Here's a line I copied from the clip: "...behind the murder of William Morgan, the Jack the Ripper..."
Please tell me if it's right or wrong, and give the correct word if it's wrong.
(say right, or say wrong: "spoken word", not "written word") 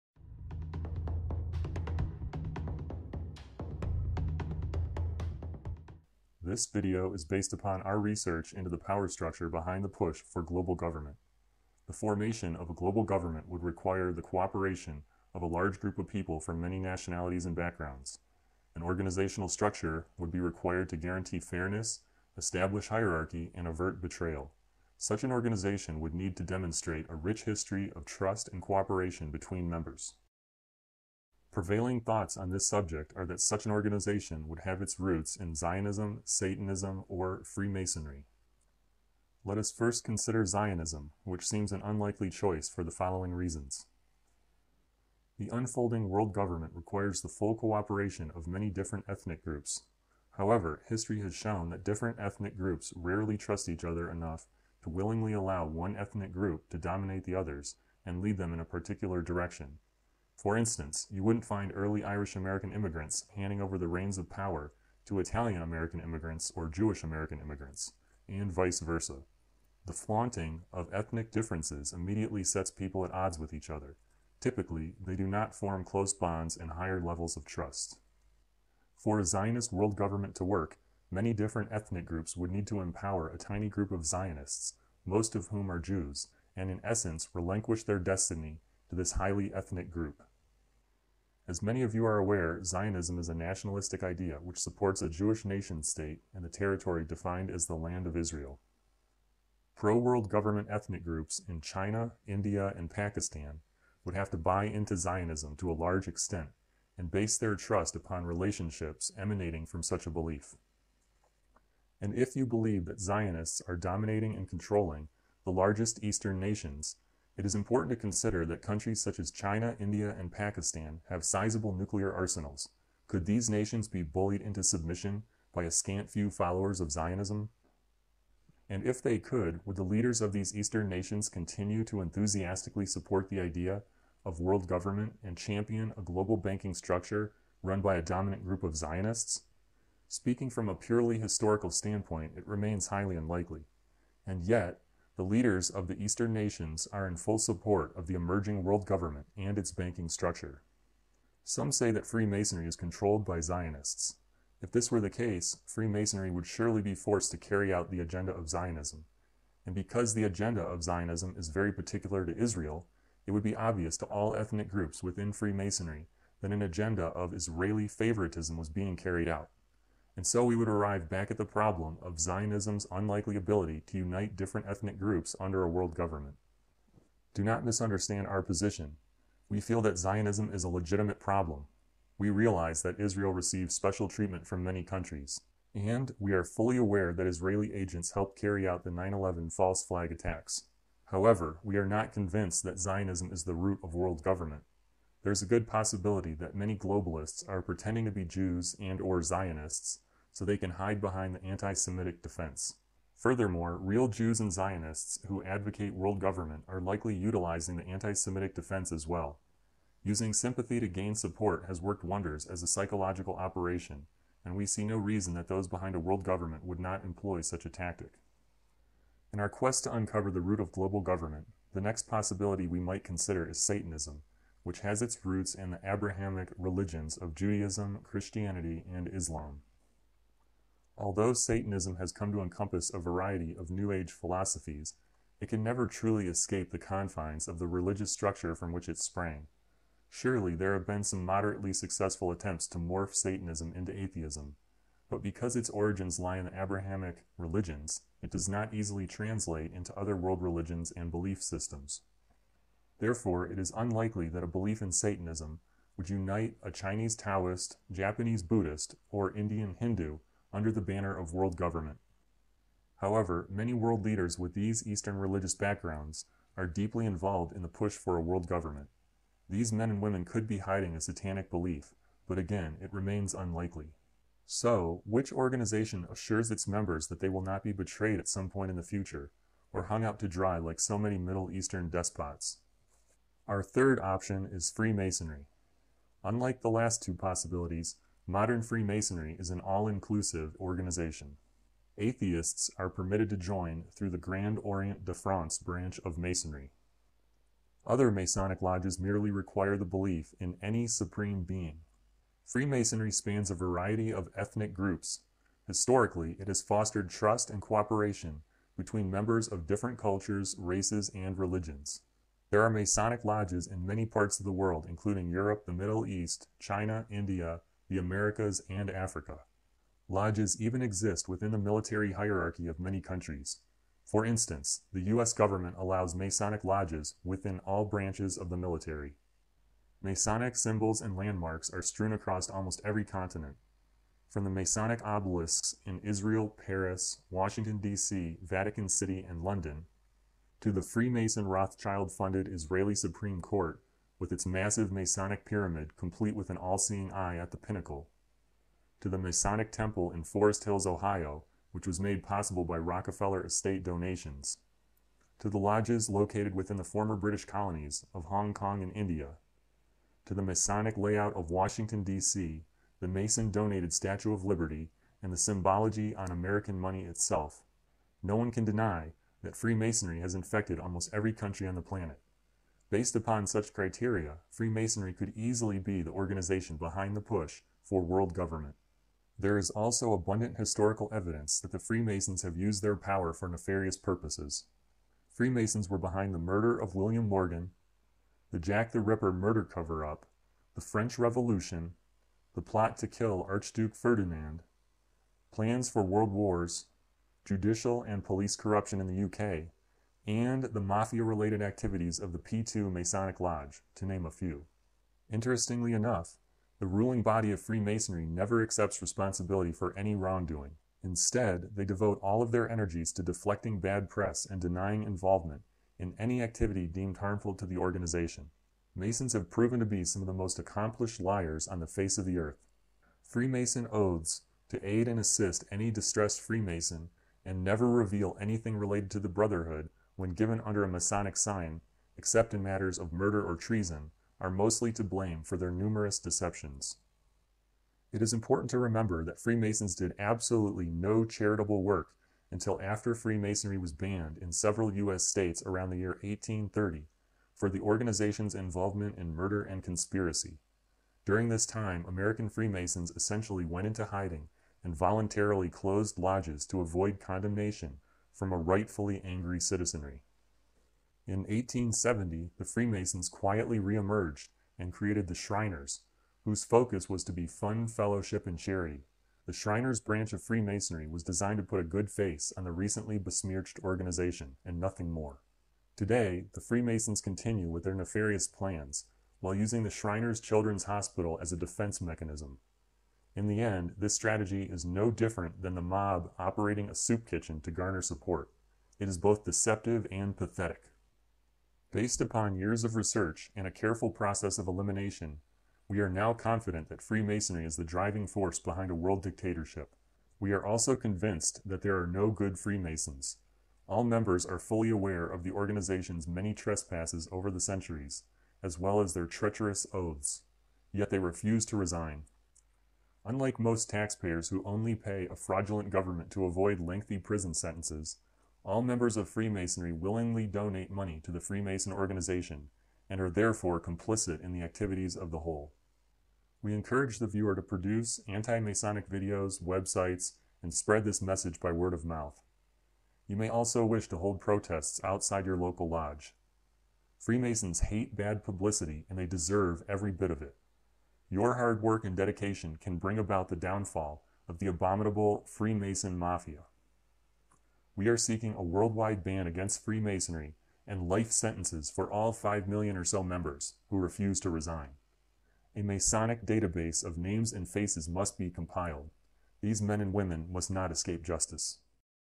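right.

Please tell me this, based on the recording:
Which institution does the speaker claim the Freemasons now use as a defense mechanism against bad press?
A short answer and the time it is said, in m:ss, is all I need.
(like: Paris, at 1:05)
Shriners Children's Hospital, at 7:59.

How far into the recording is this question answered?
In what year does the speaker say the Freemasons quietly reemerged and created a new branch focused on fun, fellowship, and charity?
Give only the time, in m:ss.
7:41.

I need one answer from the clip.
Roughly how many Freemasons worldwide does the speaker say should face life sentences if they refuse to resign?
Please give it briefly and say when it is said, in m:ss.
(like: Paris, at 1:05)
5 million, at 9:12.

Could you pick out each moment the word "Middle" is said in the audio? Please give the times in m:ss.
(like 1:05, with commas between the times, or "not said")
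4:41, 5:15.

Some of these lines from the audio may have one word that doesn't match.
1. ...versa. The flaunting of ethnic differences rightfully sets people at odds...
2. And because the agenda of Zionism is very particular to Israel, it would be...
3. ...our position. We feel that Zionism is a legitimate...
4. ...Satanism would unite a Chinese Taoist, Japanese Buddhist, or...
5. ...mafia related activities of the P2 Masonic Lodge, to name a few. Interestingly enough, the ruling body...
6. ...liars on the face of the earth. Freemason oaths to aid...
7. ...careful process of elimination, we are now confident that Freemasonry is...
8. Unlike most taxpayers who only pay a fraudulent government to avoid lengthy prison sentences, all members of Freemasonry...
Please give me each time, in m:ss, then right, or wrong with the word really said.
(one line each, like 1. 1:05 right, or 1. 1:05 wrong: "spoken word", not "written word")
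1. 1:08 wrong: "immediately", not "rightfully"
2. 2:39 right
3. 2:58 right
4. 4:14 right
5. 6:40 right
6. 7:01 right
7. 8:13 right
8. 8:33 right.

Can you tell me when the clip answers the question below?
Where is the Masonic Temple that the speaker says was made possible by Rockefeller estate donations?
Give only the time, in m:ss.
5:50.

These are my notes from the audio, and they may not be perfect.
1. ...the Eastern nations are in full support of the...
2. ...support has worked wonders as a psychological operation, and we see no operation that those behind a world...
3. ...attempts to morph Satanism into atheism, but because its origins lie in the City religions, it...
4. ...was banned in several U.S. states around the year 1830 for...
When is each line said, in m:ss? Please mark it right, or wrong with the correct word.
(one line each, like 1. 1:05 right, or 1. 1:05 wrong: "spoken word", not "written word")
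1. 2:25 right
2. 3:31 wrong: "reason", not "operation"
3. 4:02 wrong: "Abrahamic", not "City"
4. 7:23 right.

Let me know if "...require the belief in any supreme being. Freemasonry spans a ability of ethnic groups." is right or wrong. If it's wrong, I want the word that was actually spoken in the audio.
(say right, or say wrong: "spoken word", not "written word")
wrong: "variety", not "ability".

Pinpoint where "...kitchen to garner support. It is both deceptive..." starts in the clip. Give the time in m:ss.
8:07.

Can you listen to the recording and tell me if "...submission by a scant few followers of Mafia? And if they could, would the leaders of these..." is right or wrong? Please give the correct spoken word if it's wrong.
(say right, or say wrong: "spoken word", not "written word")
wrong: "Zionism", not "Mafia".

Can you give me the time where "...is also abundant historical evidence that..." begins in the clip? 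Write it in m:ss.
6:19.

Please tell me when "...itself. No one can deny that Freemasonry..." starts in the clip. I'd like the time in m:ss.
6:07.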